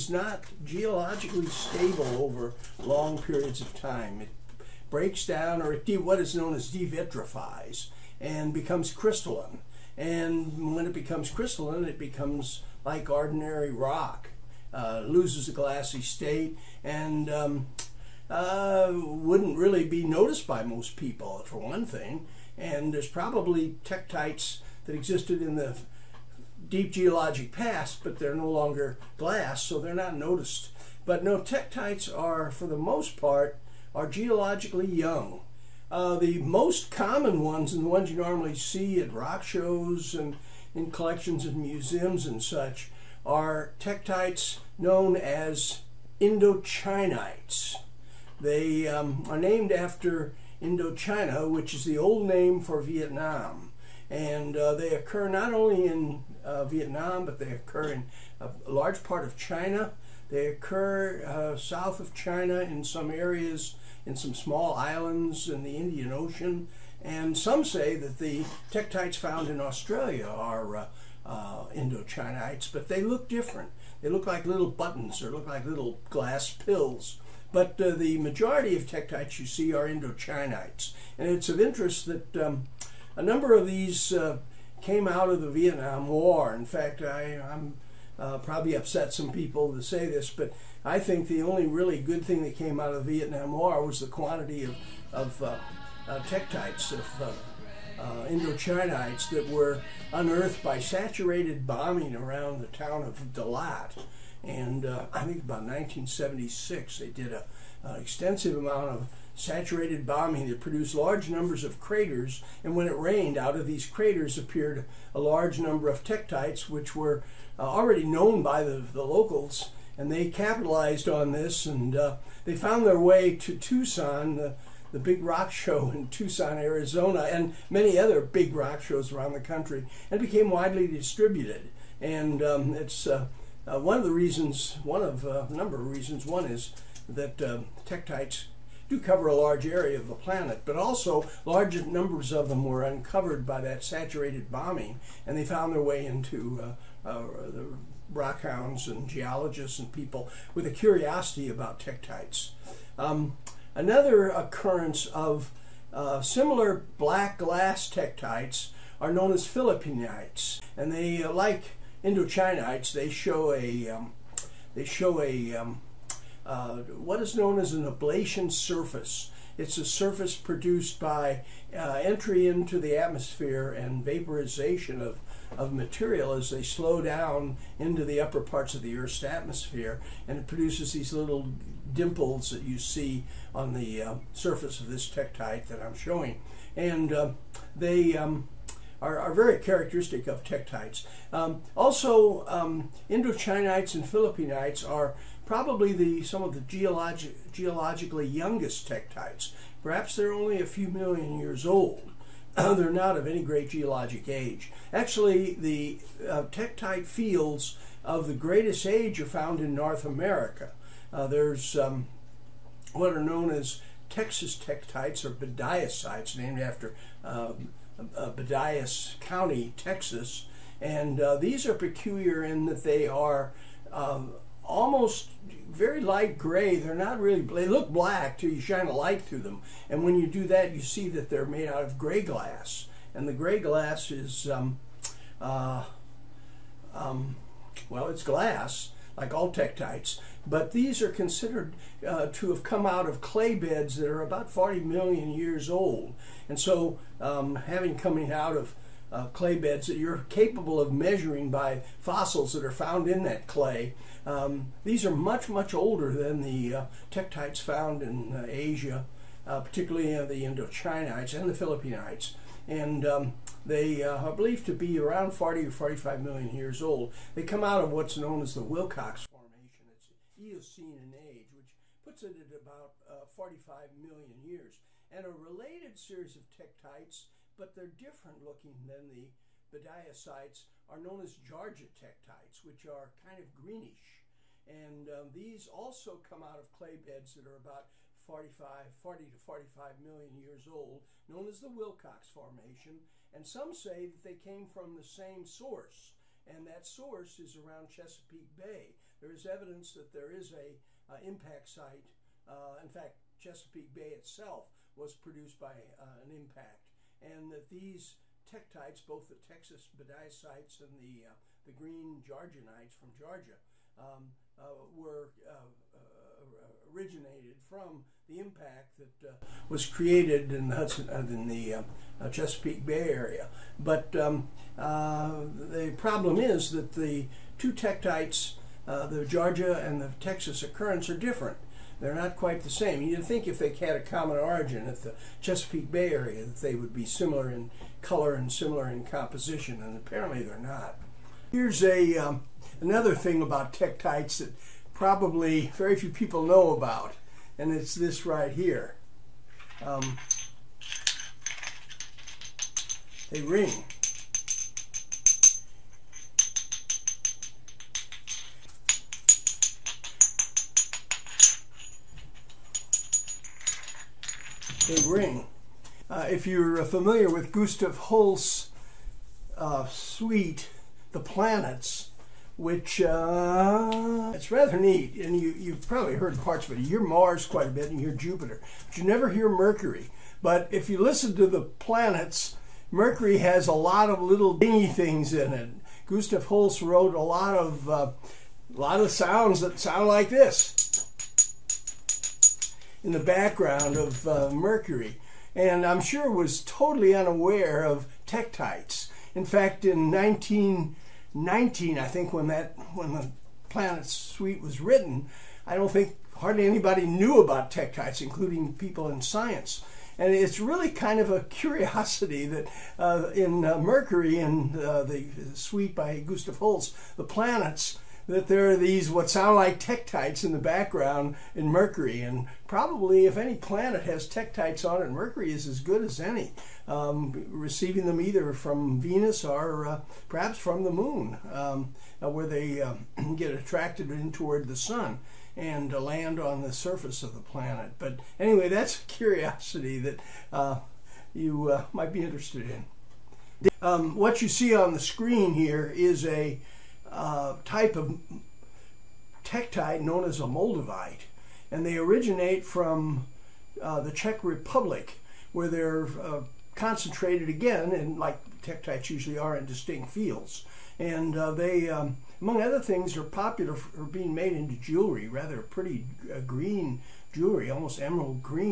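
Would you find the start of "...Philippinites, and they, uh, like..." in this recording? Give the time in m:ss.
2:39.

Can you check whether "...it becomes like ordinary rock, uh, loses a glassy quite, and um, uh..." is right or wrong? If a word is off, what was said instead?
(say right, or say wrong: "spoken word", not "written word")
wrong: "state", not "quite".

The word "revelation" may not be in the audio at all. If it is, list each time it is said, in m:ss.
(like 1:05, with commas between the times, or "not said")
not said.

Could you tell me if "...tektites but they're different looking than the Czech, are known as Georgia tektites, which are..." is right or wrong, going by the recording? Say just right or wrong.
wrong.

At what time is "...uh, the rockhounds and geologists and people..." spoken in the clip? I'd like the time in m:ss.
2:27.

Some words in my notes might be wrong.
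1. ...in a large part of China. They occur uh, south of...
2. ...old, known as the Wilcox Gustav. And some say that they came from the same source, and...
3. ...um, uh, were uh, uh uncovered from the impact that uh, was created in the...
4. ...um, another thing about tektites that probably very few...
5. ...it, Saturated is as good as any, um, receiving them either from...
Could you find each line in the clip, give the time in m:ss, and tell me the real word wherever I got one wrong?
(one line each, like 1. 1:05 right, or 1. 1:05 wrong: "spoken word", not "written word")
1. 0:57 right
2. 4:50 wrong: "Formation", not "Gustav"
3. 5:13 wrong: "originated", not "uncovered"
4. 5:42 right
5. 7:05 wrong: "Mercury", not "Saturated".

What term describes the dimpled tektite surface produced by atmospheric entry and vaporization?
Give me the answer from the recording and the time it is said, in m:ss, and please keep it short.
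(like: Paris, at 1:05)
ablation surface, at 2:47.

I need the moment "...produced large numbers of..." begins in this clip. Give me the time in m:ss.
1:50.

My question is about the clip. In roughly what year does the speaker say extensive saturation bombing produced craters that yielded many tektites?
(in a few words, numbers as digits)
1976.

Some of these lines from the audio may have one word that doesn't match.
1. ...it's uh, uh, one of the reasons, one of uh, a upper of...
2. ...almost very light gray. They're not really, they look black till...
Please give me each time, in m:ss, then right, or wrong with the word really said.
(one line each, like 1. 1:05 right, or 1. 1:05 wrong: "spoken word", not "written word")
1. 2:12 wrong: "number", not "upper"
2. 3:44 right.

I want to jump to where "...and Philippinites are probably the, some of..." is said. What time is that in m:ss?
3:13.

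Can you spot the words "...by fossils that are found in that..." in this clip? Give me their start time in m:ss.
4:11.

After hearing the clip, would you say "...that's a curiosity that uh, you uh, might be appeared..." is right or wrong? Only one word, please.
wrong.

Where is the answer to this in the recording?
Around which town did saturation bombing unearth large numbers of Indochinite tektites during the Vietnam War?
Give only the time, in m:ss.
1:43.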